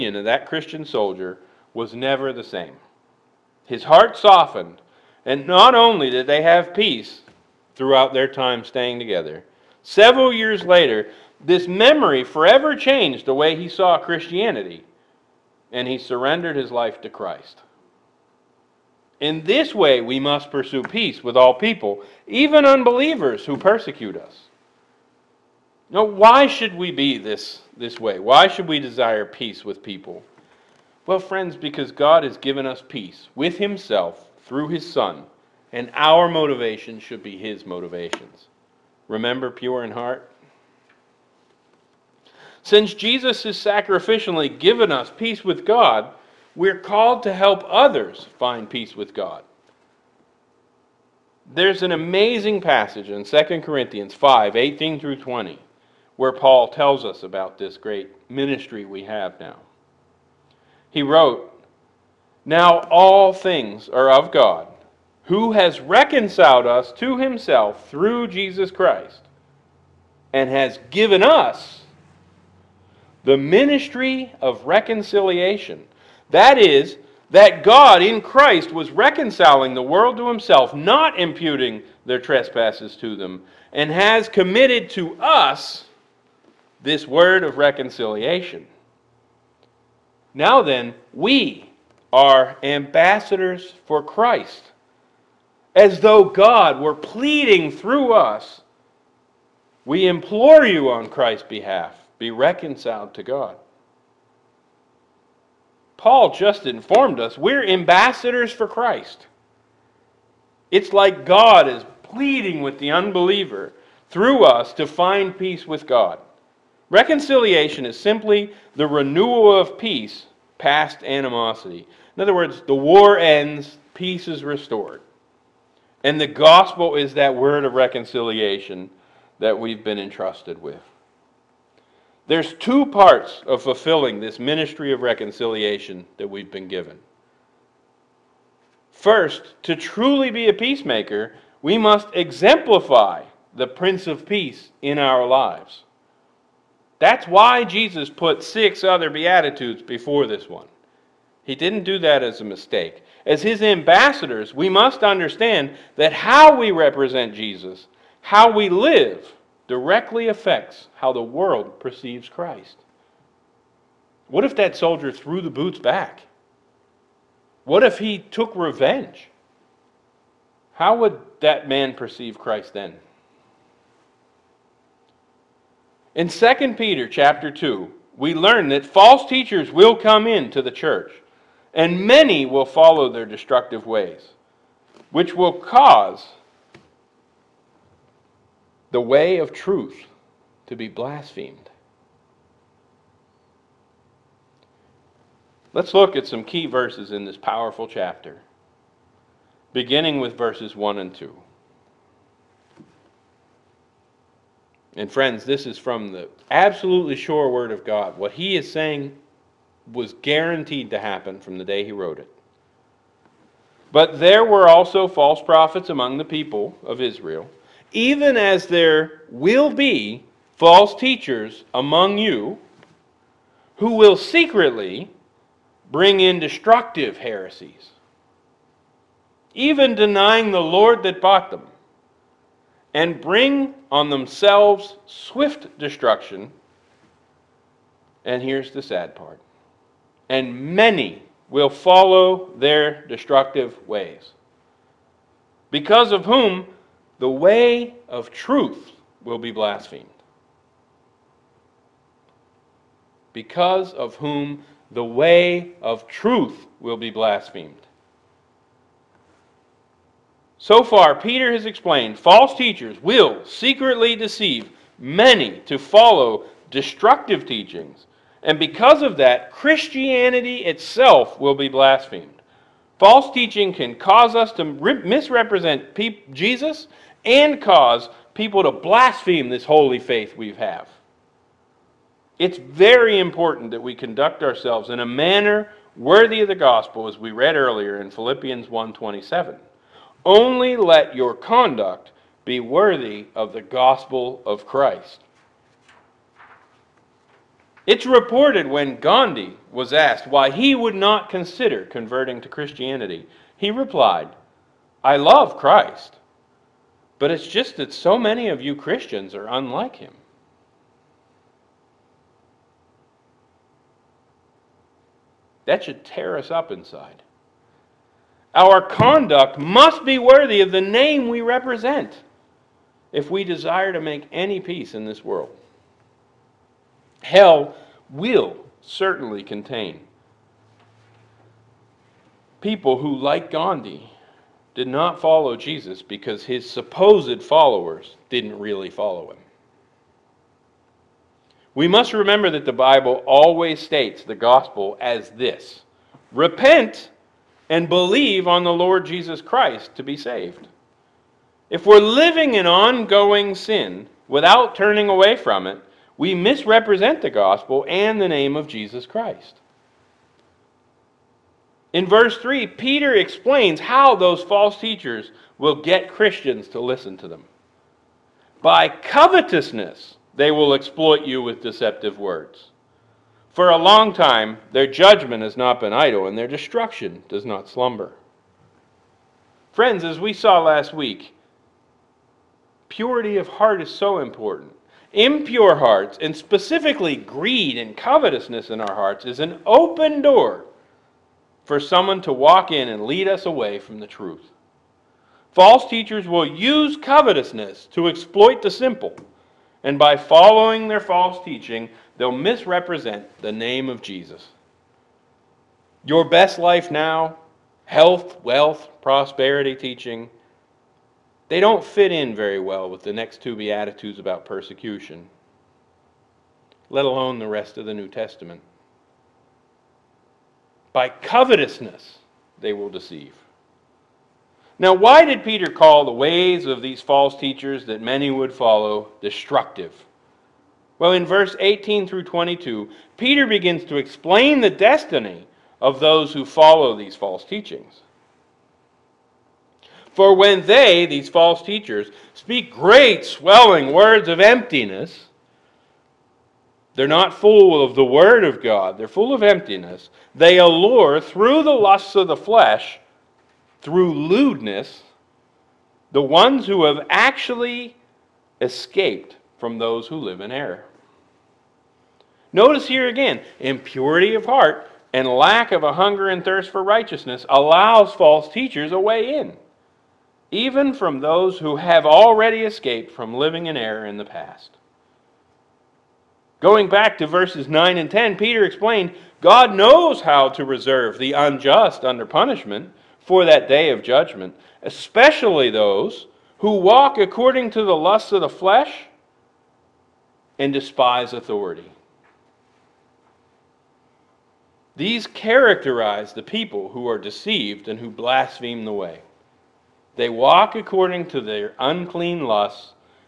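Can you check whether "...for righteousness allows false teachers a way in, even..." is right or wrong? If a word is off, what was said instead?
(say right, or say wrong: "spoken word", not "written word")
right.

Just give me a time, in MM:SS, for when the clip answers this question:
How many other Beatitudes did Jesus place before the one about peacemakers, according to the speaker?
02:28.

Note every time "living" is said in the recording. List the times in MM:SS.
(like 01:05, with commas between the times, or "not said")
05:51, 07:53.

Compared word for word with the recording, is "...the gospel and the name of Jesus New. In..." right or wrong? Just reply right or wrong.
wrong.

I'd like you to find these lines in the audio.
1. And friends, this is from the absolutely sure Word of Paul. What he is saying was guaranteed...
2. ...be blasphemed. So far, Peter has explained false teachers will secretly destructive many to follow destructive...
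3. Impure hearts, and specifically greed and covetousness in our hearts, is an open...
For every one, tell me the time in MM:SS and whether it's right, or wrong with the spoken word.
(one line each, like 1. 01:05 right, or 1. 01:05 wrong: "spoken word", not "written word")
1. 03:24 wrong: "God", not "Paul"
2. 04:16 wrong: "deceive", not "destructive"
3. 06:25 right.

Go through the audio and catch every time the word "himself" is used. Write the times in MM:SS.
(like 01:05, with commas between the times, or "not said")
00:33, 01:07, 01:20.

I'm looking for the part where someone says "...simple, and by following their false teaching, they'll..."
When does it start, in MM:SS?
06:38.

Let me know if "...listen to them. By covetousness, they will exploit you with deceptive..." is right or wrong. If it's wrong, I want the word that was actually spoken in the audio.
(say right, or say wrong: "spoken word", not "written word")
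right.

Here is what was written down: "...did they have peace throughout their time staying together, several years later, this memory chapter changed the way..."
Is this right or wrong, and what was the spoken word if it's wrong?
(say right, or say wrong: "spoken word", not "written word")
wrong: "forever", not "chapter".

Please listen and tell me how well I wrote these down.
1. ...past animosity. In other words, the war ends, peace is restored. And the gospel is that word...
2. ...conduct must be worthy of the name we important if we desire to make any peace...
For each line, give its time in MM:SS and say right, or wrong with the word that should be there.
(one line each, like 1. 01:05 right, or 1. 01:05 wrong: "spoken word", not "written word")
1. 02:00 right
2. 05:18 wrong: "represent", not "important".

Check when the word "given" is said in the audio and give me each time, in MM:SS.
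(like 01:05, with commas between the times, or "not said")
00:32, 00:44, 01:10, 02:16.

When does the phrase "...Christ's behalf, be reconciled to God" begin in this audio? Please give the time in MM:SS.
01:41.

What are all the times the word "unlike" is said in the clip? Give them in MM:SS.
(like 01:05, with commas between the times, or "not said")
05:09.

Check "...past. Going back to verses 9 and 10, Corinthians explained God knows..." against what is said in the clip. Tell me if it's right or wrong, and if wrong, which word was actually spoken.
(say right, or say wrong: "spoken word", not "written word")
wrong: "Peter", not "Corinthians".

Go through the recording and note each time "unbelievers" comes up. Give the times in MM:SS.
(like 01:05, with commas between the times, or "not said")
00:22, 01:52.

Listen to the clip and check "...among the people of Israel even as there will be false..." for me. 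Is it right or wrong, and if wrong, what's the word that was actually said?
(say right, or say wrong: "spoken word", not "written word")
right.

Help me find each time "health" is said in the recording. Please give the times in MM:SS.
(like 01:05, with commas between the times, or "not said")
06:47.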